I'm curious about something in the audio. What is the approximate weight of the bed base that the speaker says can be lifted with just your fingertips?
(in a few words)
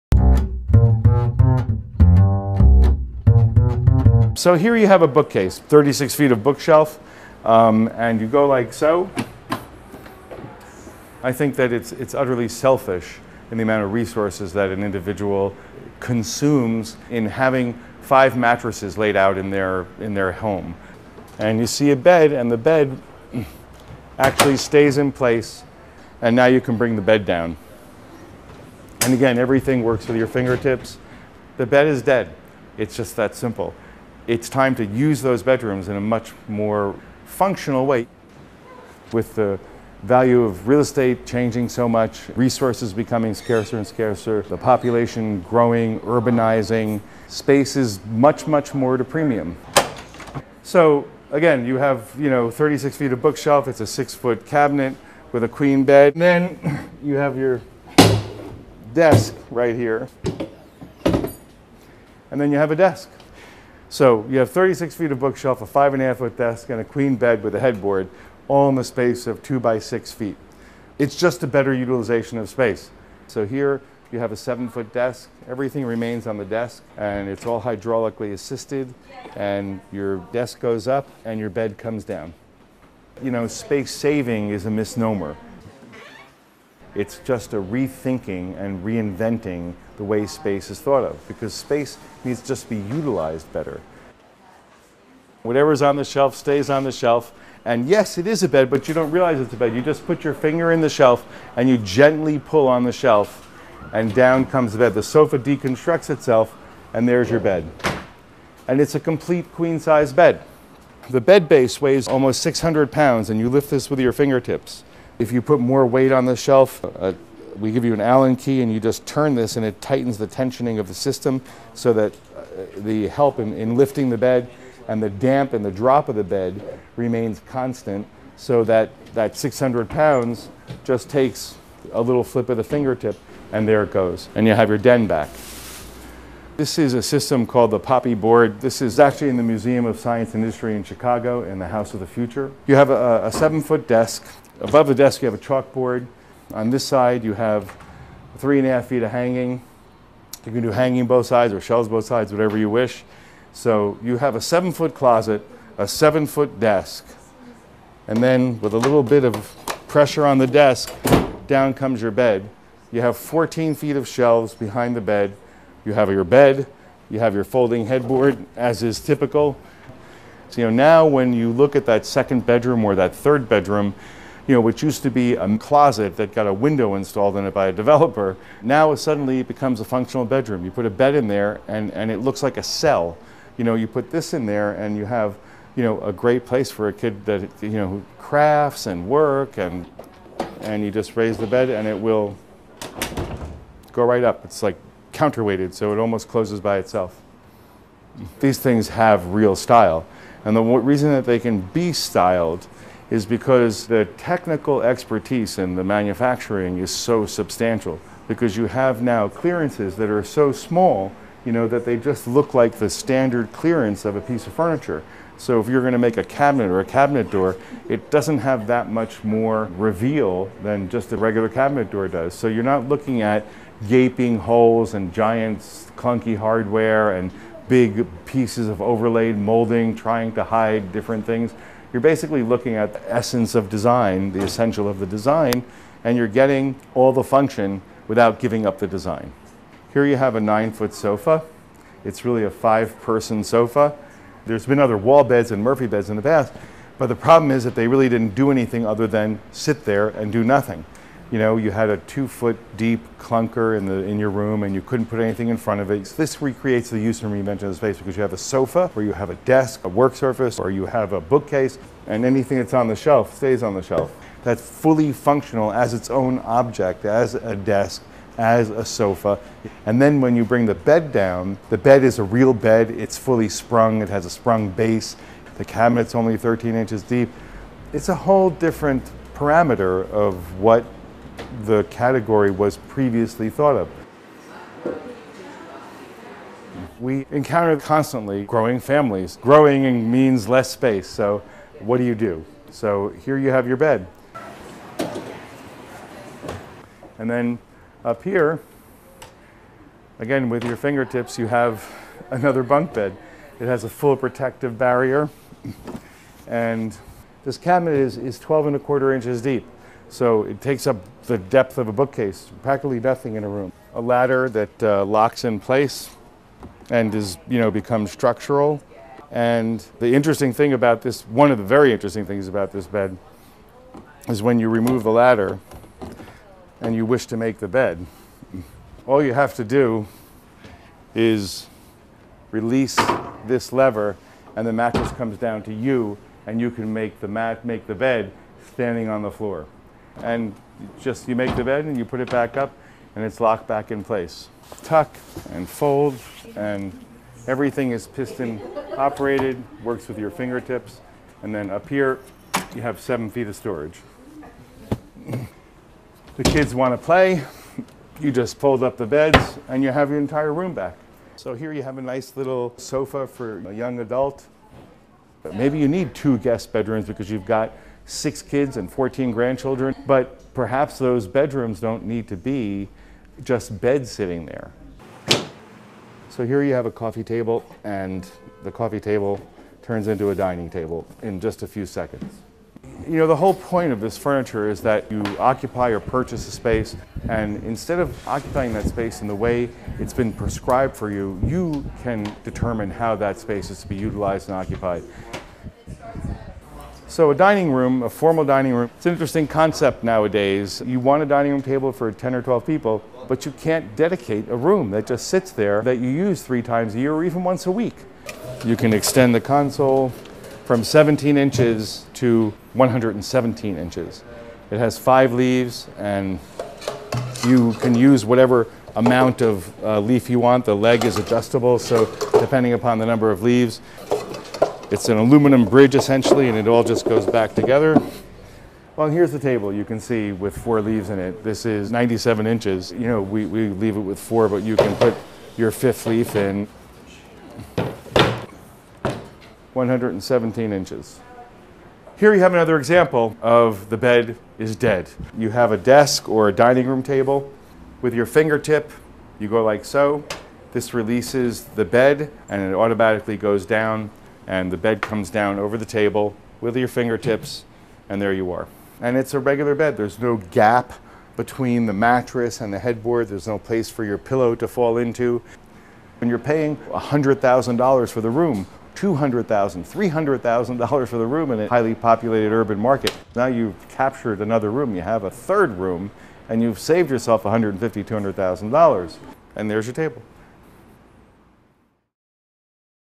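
600 pounds.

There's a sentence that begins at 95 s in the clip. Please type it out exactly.
Whatever's on the shelf stays on the shelf.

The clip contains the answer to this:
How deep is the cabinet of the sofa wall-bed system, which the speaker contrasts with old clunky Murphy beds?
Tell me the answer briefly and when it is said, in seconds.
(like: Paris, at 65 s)
13 inches, at 276 s.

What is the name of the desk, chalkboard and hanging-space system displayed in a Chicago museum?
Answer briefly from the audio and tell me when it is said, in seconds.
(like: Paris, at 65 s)
Poppy Board, at 137 s.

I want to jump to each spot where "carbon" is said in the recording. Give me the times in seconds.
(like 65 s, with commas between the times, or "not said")
not said.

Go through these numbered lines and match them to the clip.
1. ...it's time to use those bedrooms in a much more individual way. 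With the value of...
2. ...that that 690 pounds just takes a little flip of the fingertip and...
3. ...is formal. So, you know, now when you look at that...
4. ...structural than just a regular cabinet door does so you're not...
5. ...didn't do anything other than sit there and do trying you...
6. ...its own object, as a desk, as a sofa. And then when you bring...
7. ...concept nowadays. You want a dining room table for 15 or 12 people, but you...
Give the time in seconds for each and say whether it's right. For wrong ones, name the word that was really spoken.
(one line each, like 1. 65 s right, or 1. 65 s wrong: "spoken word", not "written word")
1. 34 s wrong: "functional", not "individual"
2. 128 s wrong: "600", not "690"
3. 168 s wrong: "typical", not "formal"
4. 219 s wrong: "reveal", not "structural"
5. 248 s wrong: "nothing", not "trying"
6. 265 s right
7. 399 s wrong: "10", not "15".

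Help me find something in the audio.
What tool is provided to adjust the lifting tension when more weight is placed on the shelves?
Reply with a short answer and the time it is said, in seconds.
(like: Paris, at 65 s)
Allen key, at 118 s.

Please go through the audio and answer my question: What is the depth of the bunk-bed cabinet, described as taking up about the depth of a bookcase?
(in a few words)
12 and a quarter inches.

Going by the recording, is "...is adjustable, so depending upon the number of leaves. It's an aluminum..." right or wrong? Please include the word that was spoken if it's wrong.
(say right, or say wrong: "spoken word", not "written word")
right.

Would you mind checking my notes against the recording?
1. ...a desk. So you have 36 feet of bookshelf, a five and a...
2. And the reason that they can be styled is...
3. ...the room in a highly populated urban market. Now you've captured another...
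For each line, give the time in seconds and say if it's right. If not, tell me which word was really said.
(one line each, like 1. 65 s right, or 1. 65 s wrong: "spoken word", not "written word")
1. 62 s right
2. 200 s right
3. 471 s right.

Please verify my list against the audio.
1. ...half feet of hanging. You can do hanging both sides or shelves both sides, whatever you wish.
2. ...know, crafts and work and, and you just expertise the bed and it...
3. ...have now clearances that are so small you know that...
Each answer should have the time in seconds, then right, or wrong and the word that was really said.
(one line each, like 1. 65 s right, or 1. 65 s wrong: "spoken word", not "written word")
1. 148 s right
2. 187 s wrong: "raise", not "expertise"
3. 208 s right.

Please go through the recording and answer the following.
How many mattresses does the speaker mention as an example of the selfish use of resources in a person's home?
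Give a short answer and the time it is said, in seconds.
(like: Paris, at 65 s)
5, at 18 s.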